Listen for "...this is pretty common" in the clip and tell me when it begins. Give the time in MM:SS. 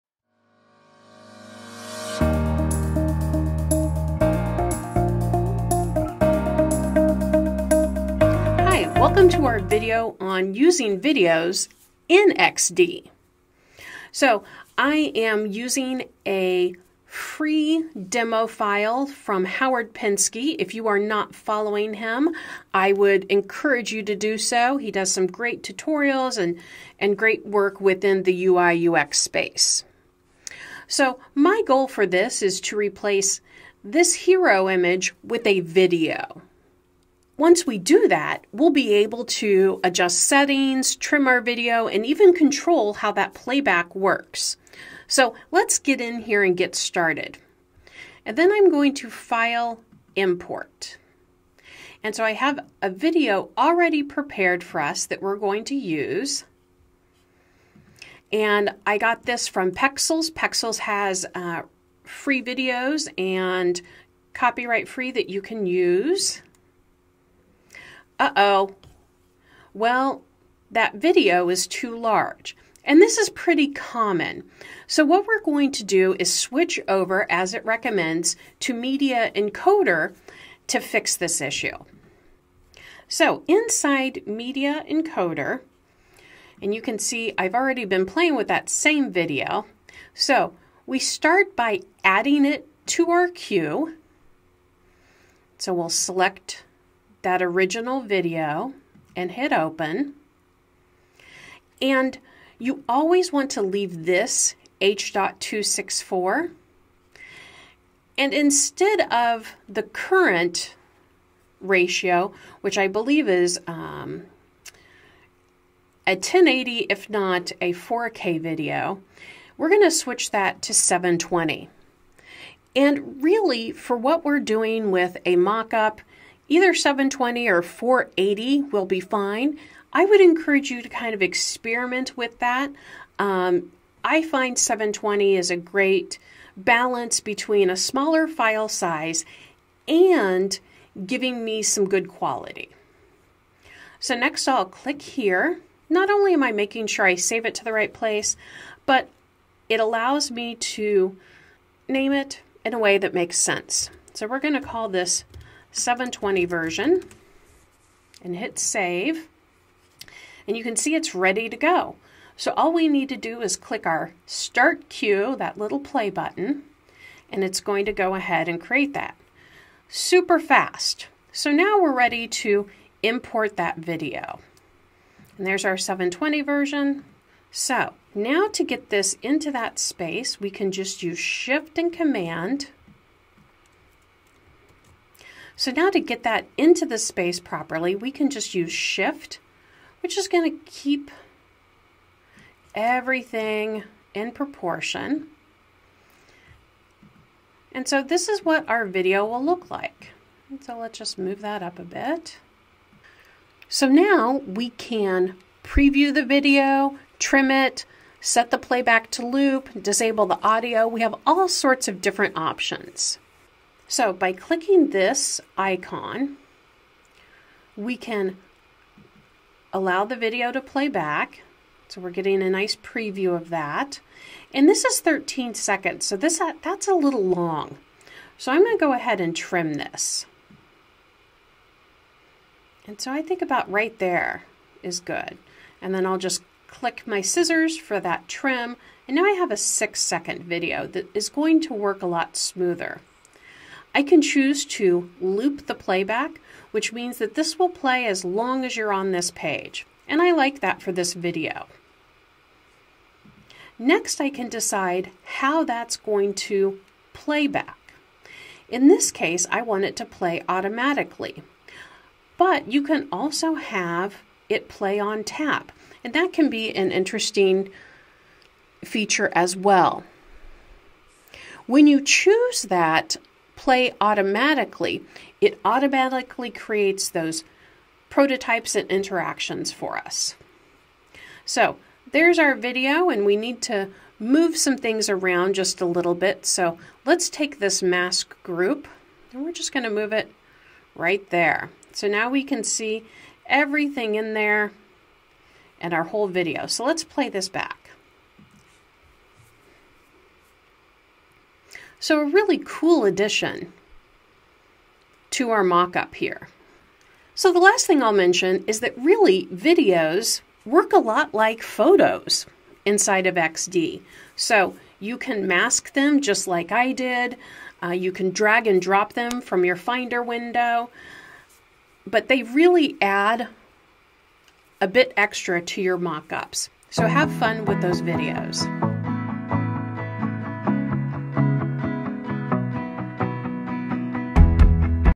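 01:13.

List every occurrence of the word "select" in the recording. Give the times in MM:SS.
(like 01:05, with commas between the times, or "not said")
01:35.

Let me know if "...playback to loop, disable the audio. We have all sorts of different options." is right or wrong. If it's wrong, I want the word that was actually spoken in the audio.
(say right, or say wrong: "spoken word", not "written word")
right.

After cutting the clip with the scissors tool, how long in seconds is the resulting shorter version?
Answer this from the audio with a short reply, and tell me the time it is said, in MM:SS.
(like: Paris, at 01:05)
6 seconds, at 03:59.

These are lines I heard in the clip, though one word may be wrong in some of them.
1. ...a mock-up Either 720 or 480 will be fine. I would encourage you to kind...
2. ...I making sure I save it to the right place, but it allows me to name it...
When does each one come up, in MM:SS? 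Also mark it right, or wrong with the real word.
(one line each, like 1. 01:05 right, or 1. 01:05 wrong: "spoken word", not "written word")
1. 02:05 right
2. 02:26 right.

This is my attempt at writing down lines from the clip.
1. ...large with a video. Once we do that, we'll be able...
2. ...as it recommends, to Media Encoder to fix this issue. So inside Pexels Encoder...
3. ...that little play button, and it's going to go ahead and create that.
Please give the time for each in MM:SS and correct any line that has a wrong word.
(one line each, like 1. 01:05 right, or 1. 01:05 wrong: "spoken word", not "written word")
1. 00:34 wrong: "image", not "large"
2. 01:17 wrong: "Media", not "Pexels"
3. 02:45 right.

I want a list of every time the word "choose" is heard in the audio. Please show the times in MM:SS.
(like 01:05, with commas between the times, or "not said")
04:04, 04:32.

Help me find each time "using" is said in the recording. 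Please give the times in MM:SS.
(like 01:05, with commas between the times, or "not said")
00:10, 00:15.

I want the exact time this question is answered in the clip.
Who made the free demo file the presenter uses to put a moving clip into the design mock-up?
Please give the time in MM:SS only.
00:19.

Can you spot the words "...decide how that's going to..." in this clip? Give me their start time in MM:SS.
04:14.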